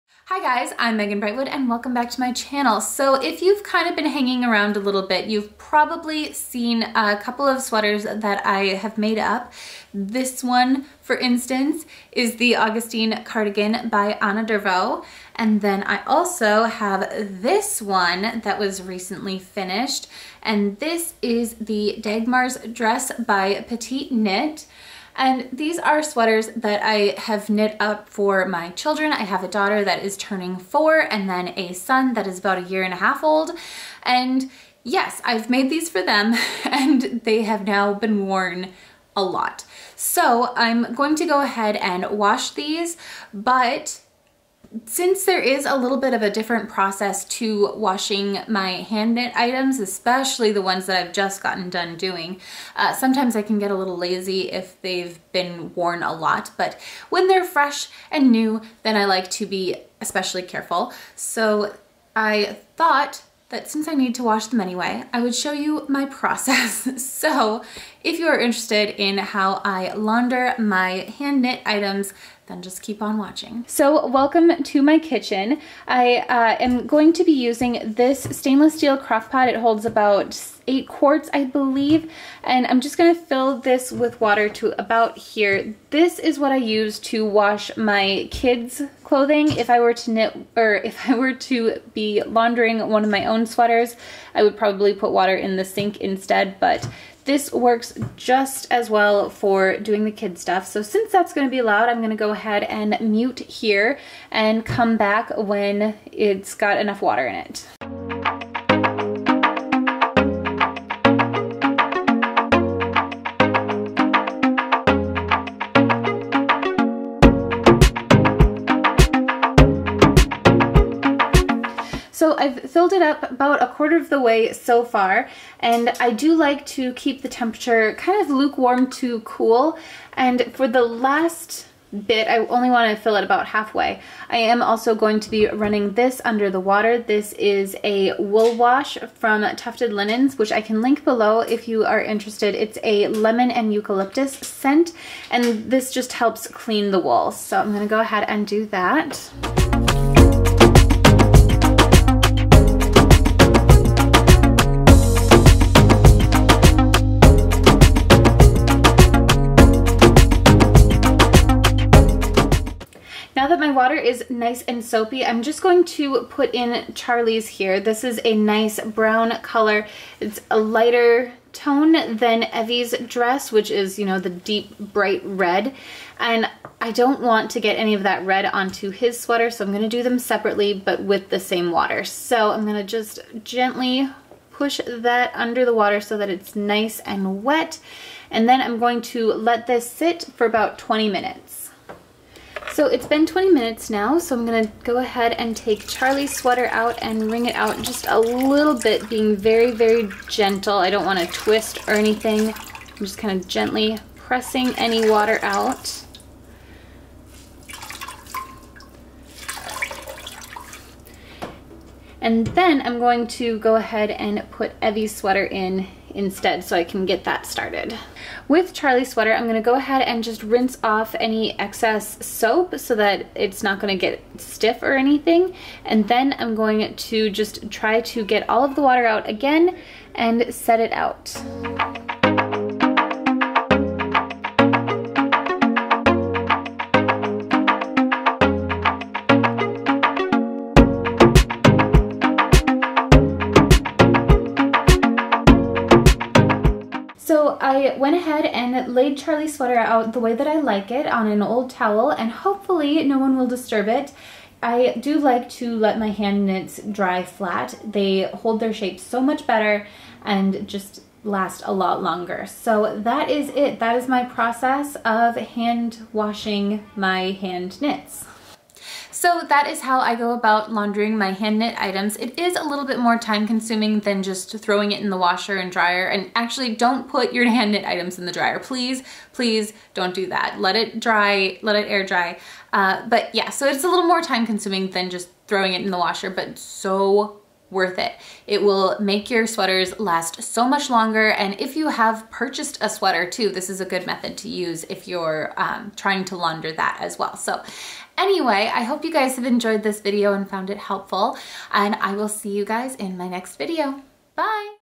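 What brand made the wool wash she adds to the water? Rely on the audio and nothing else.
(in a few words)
Tuft Woolens.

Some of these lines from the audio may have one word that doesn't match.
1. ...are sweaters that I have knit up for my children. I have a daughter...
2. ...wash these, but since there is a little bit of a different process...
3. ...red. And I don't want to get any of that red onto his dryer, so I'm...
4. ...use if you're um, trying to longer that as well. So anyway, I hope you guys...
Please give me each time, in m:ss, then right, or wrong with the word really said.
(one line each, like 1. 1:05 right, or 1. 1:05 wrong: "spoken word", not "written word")
1. 0:25 right
2. 0:42 right
3. 2:55 wrong: "sweater", not "dryer"
4. 4:54 wrong: "launder", not "longer".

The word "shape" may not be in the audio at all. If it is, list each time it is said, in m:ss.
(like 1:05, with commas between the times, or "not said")
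4:18.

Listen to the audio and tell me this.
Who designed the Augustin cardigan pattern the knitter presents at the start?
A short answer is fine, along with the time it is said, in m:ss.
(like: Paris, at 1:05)
Anna Dervout, at 0:14.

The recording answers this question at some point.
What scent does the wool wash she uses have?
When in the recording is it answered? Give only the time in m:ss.
2:23.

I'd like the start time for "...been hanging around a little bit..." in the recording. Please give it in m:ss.
0:03.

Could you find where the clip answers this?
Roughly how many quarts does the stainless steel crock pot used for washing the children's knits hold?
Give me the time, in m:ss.
1:20.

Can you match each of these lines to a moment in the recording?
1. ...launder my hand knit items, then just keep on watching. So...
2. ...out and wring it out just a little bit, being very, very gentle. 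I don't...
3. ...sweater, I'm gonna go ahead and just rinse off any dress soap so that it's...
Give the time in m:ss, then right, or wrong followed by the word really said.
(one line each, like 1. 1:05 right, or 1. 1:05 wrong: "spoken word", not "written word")
1. 1:09 right
2. 3:16 right
3. 3:39 wrong: "excess", not "dress".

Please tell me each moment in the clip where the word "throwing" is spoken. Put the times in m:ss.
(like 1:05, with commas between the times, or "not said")
4:34, 4:45.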